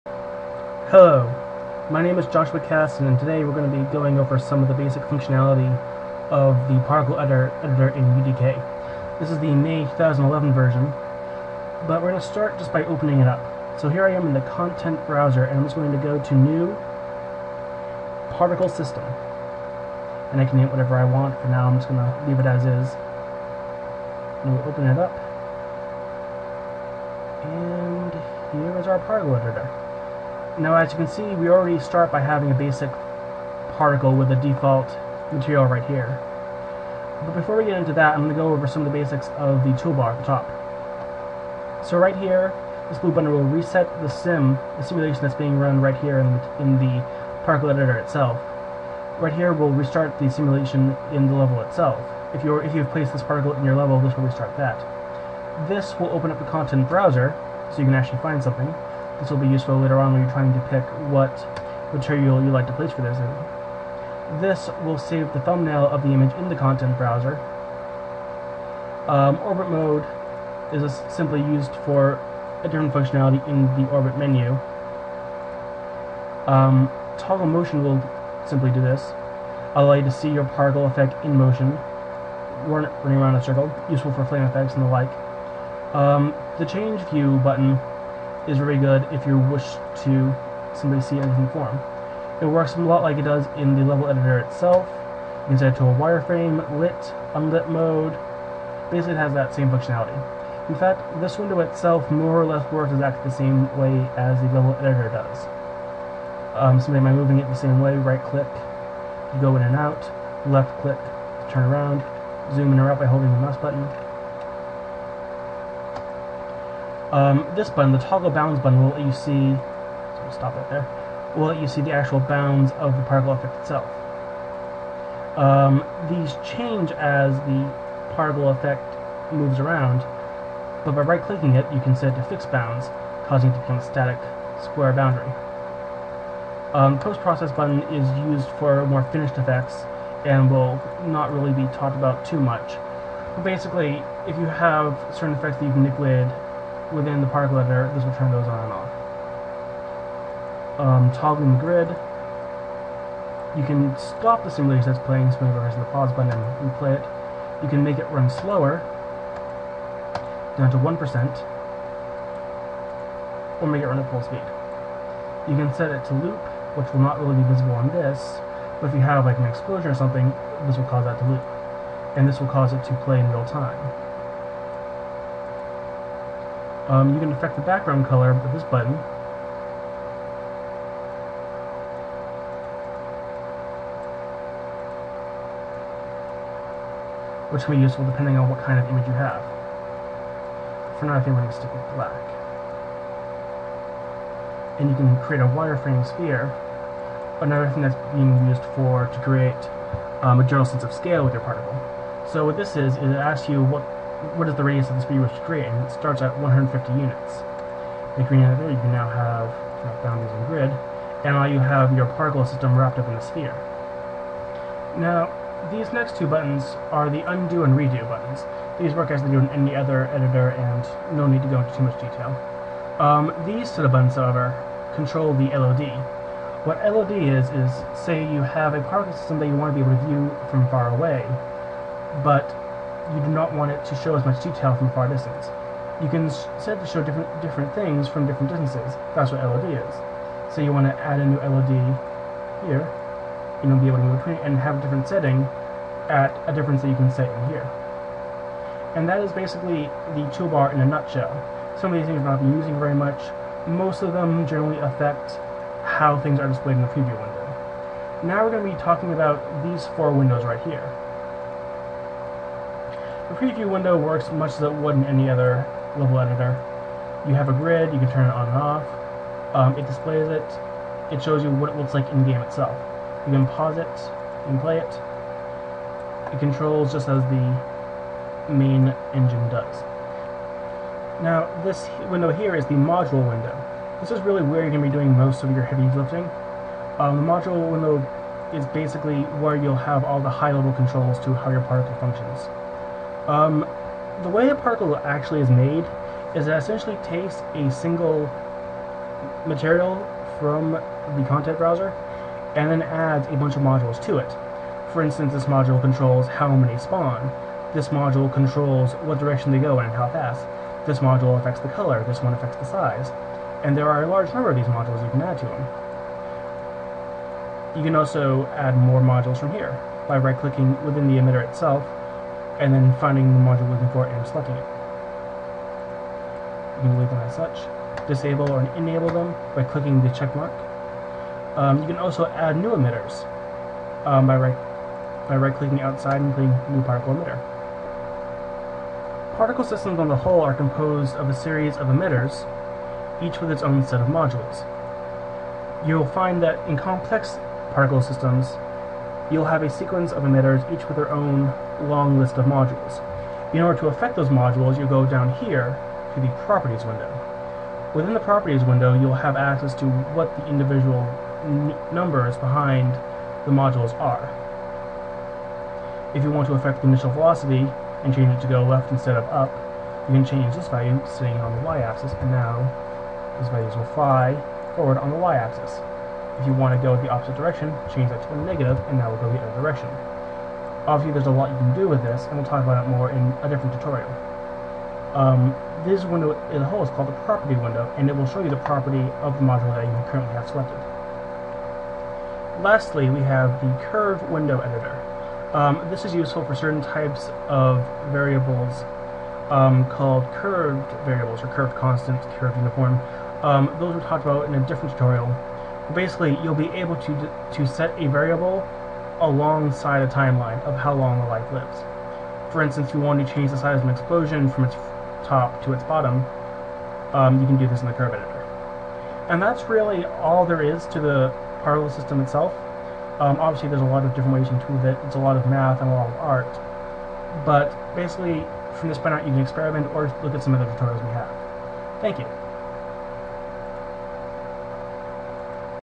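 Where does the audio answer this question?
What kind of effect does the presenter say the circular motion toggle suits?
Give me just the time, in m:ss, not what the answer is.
1:24.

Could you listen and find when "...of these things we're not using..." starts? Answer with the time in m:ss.
4:11.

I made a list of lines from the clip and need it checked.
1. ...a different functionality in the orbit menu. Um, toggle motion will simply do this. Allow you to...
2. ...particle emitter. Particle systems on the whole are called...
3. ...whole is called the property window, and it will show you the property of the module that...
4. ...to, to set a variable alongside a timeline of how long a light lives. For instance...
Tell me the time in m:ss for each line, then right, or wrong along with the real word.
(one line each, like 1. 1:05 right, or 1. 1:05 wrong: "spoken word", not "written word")
1. 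1:12 right
2. 5:36 wrong: "composed", not "called"
3. 6:26 right
4. 6:46 right.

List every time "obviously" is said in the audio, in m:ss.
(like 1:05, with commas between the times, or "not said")
6:20, 7:03.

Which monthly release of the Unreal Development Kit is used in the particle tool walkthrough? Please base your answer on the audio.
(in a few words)
May 2011.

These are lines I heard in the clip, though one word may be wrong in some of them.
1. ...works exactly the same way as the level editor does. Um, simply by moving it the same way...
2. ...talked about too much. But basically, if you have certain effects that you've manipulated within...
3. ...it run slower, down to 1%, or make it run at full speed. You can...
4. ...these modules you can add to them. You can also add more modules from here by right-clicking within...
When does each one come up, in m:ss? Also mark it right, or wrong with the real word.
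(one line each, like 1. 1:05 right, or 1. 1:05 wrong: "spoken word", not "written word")
1. 1:42 right
2. 2:21 right
3. 2:37 right
4. 5:14 right.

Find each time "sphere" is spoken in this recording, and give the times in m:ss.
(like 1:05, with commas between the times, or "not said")
3:16, 3:33.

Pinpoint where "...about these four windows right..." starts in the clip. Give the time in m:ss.
4:19.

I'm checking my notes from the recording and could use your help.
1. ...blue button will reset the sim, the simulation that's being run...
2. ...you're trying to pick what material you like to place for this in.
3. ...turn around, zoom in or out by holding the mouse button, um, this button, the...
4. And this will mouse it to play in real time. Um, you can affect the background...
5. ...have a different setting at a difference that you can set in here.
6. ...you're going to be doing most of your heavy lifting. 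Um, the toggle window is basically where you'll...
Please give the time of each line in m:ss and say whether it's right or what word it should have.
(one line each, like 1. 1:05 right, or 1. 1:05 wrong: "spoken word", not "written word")
1. 0:42 right
2. 1:00 right
3. 1:51 right
4. 2:52 wrong: "cause", not "mouse"
5. 4:04 right
6. 4:44 wrong: "module", not "toggle".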